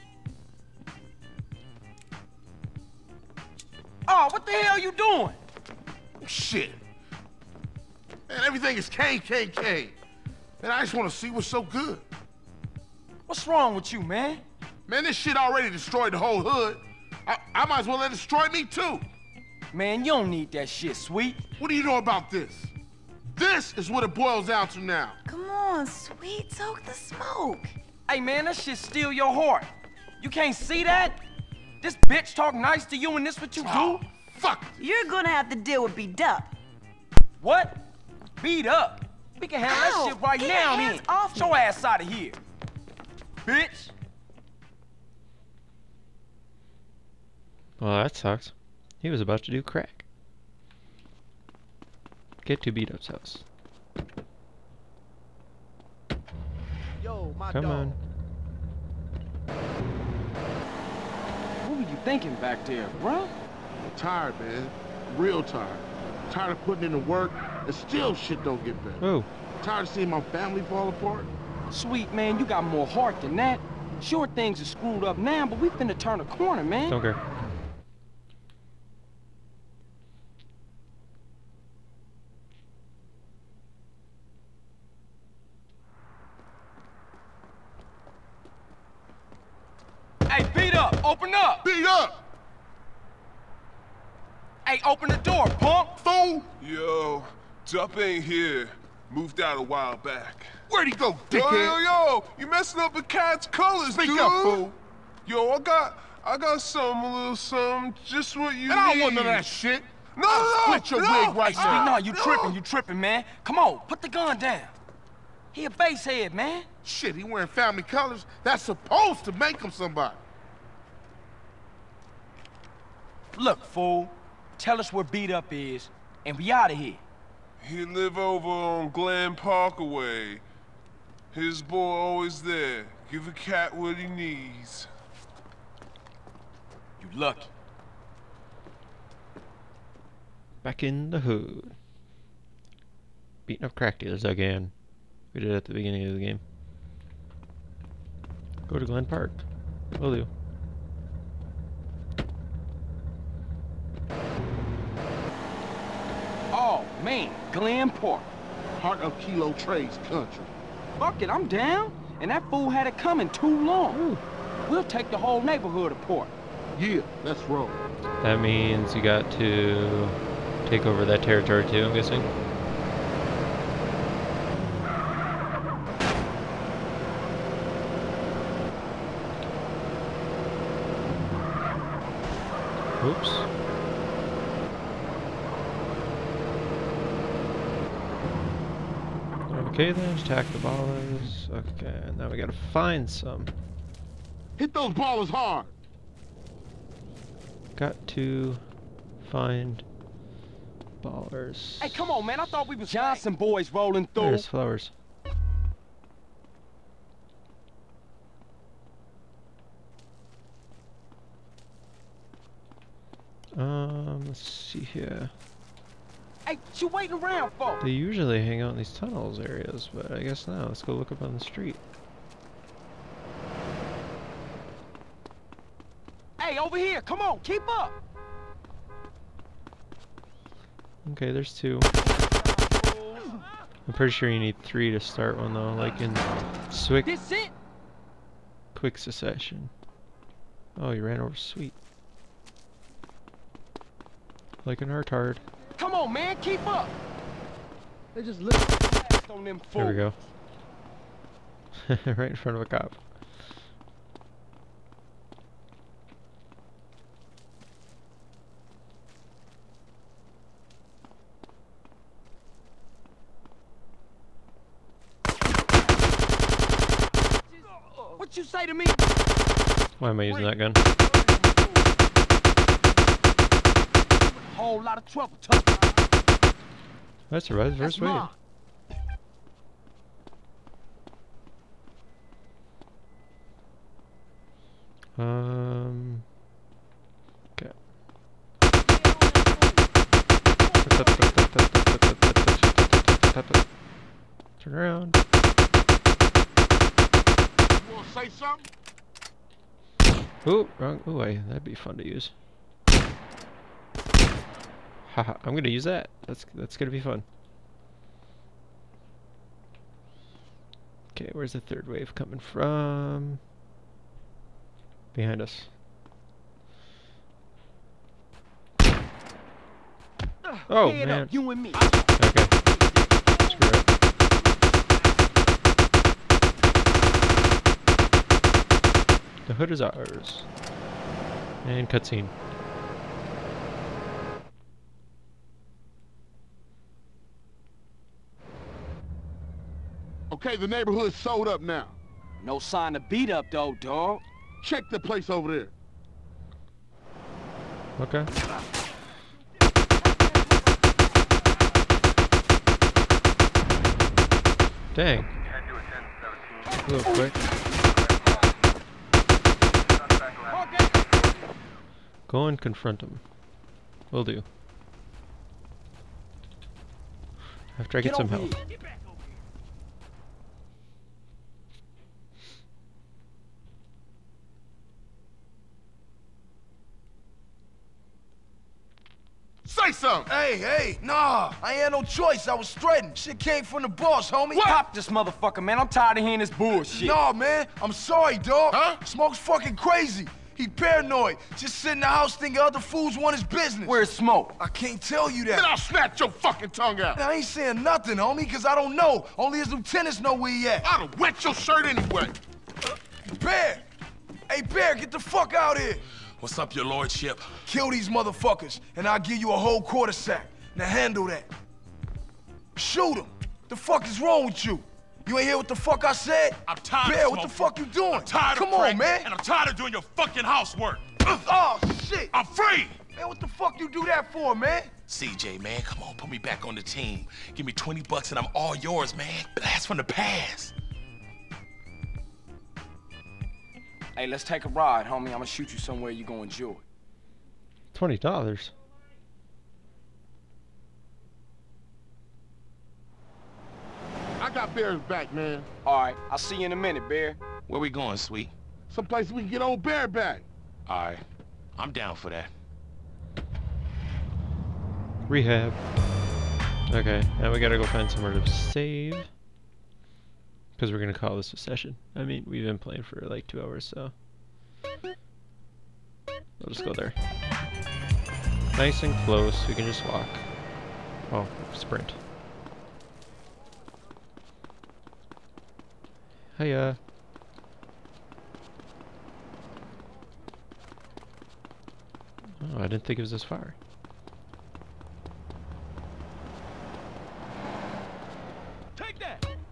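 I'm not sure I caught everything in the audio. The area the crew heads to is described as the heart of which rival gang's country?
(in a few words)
Kilo Trades.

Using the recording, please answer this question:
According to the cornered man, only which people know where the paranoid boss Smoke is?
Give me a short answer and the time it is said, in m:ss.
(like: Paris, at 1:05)
his lieutenants, at 6:39.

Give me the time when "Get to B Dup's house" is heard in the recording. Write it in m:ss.
0:52.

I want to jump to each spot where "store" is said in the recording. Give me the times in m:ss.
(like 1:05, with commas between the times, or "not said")
not said.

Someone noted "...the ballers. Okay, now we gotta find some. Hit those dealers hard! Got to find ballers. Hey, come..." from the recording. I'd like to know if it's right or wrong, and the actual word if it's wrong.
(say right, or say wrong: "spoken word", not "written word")
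wrong: "ballers", not "dealers".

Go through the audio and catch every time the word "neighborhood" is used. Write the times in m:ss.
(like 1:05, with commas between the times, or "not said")
2:45, 5:40.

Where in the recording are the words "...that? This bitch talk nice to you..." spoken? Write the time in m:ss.
0:30.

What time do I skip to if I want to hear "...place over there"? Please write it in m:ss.
5:44.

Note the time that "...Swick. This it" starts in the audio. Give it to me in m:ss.
3:56.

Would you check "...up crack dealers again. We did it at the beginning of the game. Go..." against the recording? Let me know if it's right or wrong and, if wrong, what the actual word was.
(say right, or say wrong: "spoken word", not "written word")
right.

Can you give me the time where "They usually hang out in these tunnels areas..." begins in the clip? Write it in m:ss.
3:37.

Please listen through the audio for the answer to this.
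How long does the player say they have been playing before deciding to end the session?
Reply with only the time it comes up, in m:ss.
7:43.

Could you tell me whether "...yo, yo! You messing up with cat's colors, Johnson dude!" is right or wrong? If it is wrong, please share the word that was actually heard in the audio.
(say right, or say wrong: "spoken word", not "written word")
wrong: "Speak", not "Johnson".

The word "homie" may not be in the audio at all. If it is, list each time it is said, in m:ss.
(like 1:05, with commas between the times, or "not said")
6:24, 6:38, 7:15.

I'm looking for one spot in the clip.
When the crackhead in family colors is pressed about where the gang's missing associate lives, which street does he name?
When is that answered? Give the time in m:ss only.
2:08.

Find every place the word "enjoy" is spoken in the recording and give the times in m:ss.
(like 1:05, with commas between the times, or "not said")
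7:16.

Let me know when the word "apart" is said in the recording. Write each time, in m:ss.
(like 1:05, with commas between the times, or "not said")
1:10, 2:45.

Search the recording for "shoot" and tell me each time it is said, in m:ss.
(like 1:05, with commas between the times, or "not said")
6:52, 7:15.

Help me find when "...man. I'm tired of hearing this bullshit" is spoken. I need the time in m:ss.
6:25.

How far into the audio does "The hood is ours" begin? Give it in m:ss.
5:29.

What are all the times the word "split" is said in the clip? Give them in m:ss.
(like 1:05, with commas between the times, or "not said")
1:50.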